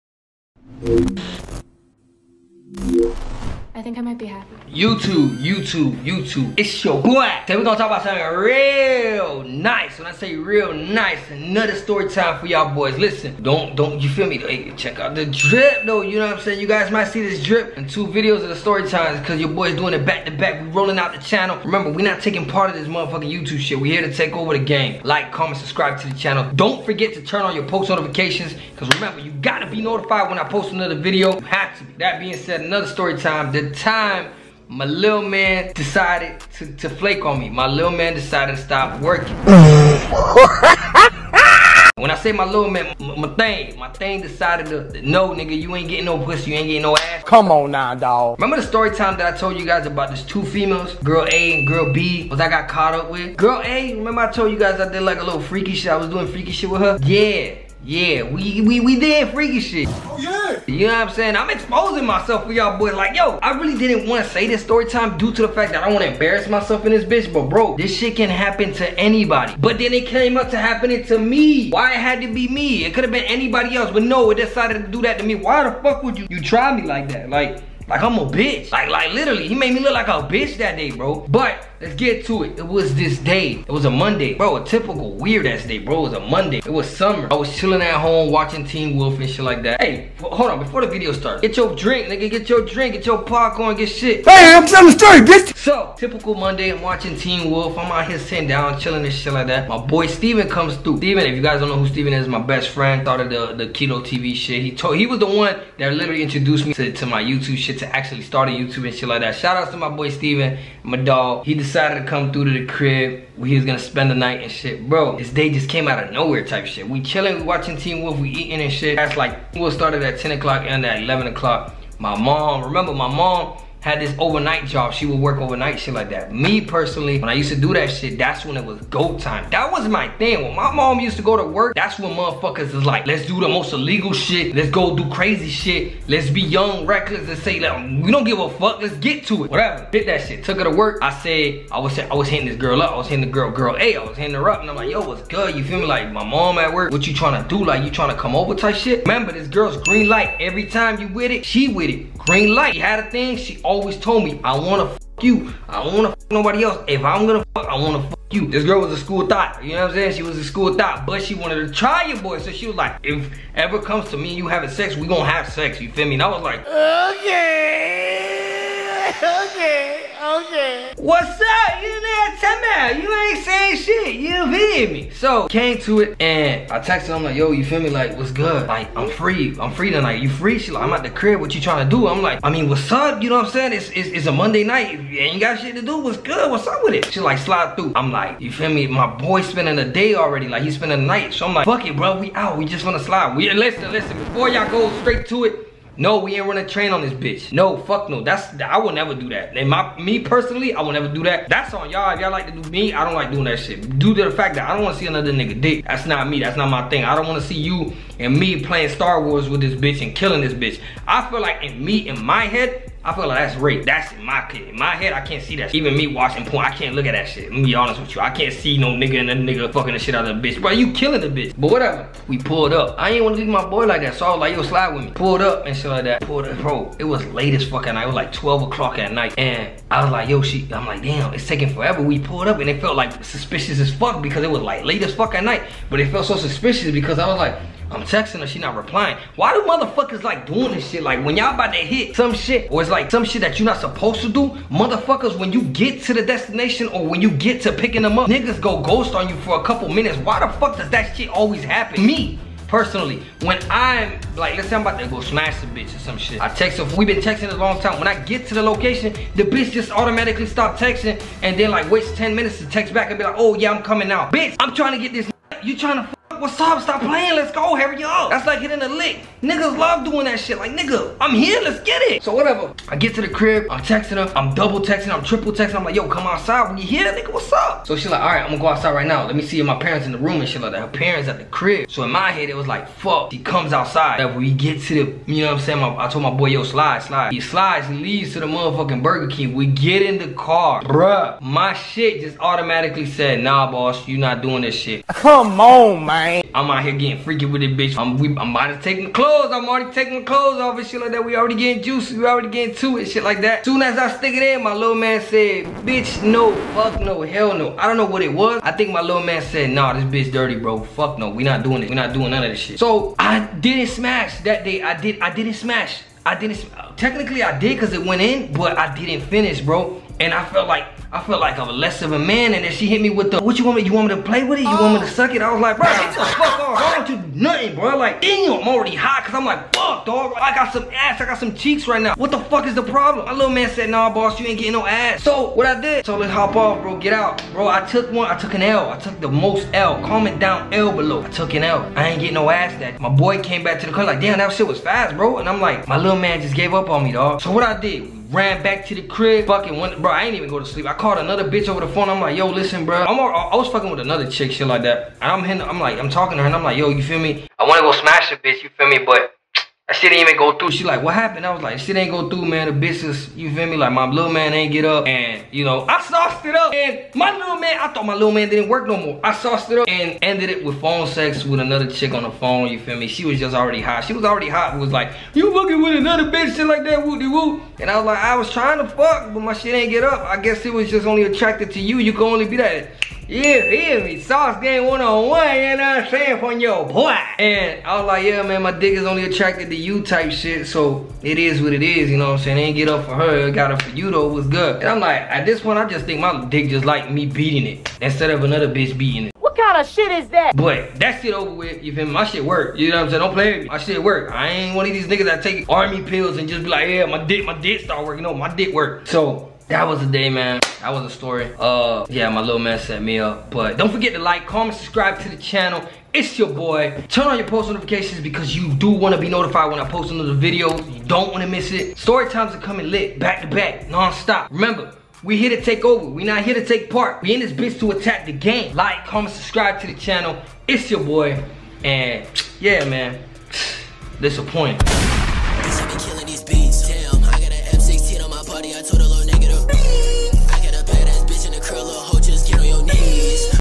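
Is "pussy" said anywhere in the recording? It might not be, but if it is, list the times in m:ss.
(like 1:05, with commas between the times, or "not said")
0:46.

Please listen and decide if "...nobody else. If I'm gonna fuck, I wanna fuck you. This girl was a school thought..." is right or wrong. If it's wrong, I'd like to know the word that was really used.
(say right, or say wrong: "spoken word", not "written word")
right.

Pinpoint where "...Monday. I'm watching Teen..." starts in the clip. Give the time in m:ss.
1:36.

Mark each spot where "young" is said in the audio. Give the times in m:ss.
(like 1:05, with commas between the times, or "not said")
2:16.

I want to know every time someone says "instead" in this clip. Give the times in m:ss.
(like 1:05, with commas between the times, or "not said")
6:38.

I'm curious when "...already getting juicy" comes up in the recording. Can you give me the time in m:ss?
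5:01.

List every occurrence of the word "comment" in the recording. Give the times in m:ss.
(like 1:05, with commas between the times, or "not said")
0:25, 5:40, 6:54, 7:09.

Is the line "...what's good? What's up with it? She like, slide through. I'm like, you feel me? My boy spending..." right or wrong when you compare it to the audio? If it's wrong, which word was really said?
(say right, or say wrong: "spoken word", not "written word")
right.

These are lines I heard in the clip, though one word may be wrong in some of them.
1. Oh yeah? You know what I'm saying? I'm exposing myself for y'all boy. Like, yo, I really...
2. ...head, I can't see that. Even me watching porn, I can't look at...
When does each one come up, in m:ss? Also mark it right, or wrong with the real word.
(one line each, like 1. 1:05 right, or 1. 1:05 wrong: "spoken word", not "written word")
1. 0:59 right
2. 3:34 right.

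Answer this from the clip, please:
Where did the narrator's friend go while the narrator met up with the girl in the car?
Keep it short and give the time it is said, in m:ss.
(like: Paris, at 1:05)
Burger King, at 4:49.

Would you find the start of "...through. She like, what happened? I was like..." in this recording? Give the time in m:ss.
6:00.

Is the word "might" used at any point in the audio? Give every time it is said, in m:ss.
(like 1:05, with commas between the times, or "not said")
0:04, 0:16.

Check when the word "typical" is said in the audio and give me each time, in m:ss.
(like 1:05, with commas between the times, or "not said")
1:24, 1:35.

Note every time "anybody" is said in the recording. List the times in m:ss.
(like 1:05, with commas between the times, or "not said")
1:08, 1:13.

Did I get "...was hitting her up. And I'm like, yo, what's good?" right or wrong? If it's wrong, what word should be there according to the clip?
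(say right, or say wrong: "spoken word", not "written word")
right.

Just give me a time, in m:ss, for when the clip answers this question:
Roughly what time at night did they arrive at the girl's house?
3:48.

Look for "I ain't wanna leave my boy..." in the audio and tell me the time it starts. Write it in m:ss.
3:42.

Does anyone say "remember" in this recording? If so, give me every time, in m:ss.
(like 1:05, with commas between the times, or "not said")
0:21, 0:28, 0:48, 0:53, 2:02, 2:29, 7:04.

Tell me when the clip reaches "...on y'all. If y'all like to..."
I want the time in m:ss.
3:21.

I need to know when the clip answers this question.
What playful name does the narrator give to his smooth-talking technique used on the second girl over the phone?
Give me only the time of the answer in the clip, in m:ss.
6:24.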